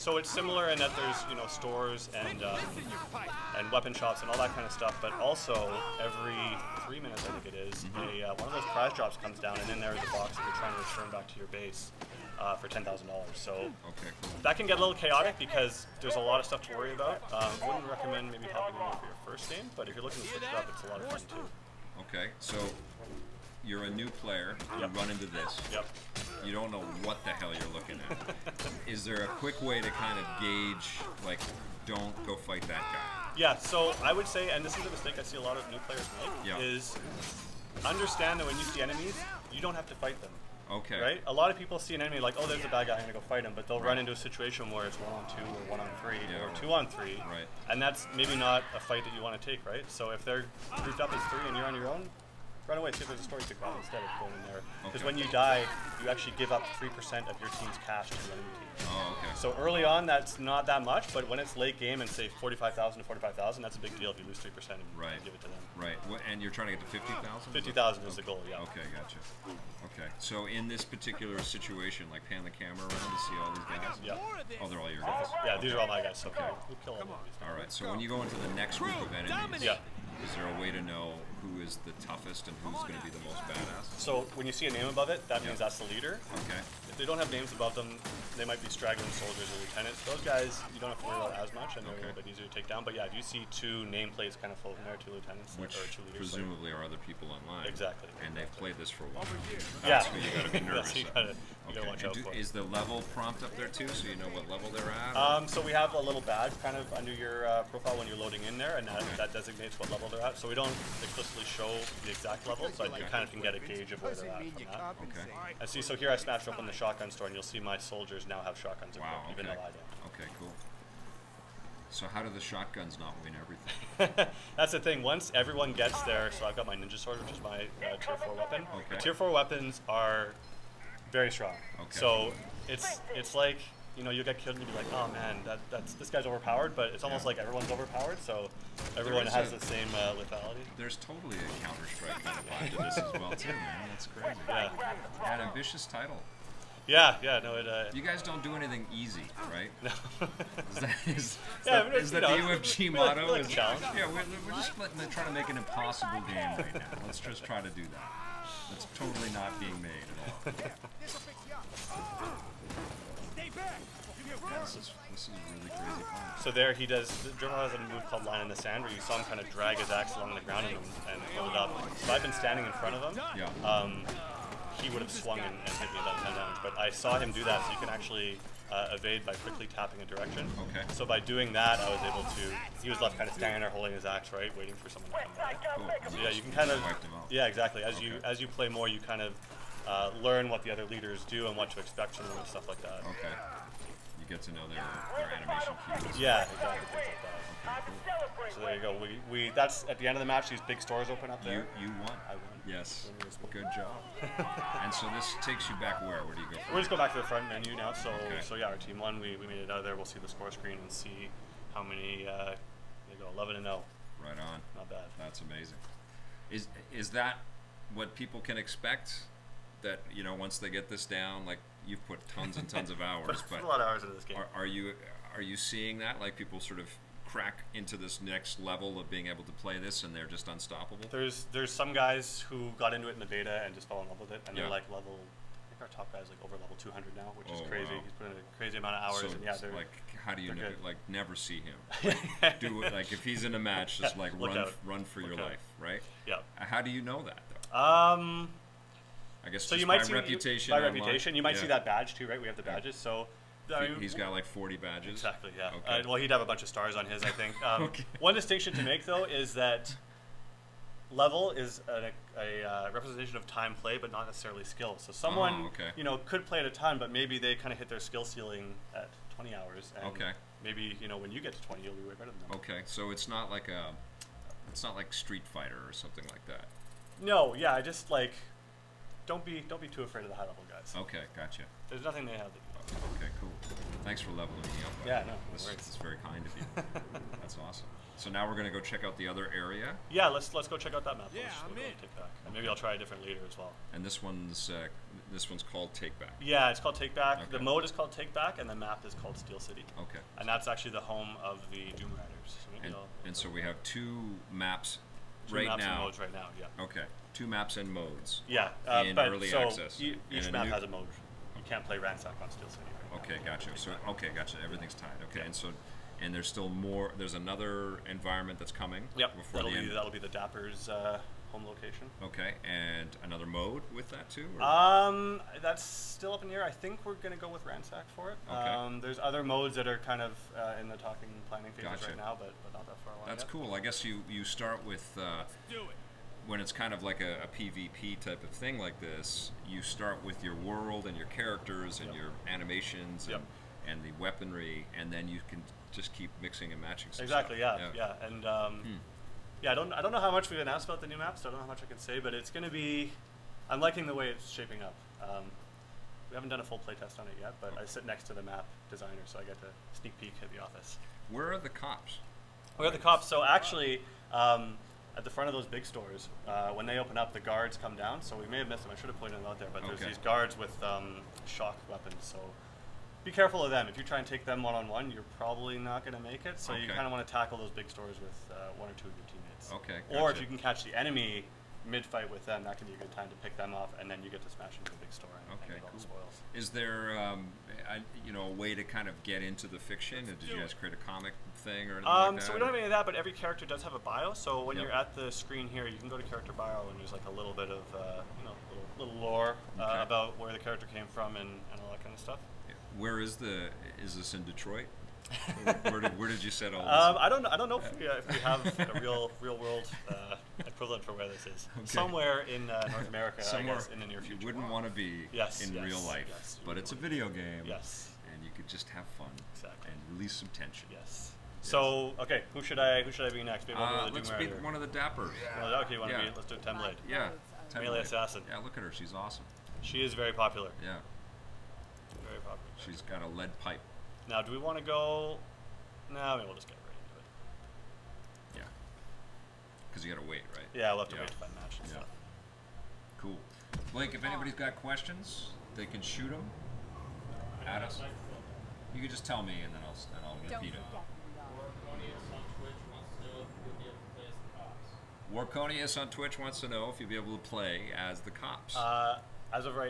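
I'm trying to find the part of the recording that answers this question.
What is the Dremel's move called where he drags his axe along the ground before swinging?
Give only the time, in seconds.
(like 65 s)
168 s.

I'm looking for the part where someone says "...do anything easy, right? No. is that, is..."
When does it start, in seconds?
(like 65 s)
148 s.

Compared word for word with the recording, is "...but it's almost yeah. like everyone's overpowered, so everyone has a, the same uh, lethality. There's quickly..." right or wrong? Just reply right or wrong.
wrong.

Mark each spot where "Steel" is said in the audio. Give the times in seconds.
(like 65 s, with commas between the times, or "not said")
299 s, 312 s.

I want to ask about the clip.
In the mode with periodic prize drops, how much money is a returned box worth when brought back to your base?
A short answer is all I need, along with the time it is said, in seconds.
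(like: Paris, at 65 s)
$10,000, at 12 s.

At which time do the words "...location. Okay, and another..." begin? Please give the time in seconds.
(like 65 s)
321 s.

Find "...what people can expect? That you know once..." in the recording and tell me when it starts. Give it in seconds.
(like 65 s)
217 s.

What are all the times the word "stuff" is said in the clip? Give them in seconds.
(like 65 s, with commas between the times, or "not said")
4 s, 16 s, 192 s, 347 s, 402 s, 441 s.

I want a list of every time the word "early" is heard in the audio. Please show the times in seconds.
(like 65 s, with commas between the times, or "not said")
59 s, 309 s.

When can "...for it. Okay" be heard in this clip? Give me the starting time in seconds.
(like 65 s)
328 s.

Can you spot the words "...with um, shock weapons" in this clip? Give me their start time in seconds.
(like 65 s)
370 s.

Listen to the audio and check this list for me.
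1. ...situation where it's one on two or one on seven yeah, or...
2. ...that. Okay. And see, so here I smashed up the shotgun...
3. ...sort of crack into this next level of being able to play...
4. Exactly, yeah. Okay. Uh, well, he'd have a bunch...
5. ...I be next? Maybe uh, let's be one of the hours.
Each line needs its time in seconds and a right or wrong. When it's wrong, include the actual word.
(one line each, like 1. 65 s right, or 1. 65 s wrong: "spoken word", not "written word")
1. 44 s wrong: "three", not "seven"
2. 114 s right
3. 226 s right
4. 255 s right
5. 423 s wrong: "dappers", not "hours".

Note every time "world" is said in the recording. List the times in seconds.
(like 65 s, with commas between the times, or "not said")
340 s, 409 s.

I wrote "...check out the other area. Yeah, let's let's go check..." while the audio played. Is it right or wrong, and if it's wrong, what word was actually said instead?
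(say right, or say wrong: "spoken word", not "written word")
right.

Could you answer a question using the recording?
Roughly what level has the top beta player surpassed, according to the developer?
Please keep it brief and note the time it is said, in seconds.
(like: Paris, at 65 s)
200, at 236 s.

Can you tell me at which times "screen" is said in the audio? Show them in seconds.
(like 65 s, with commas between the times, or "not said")
210 s, 395 s.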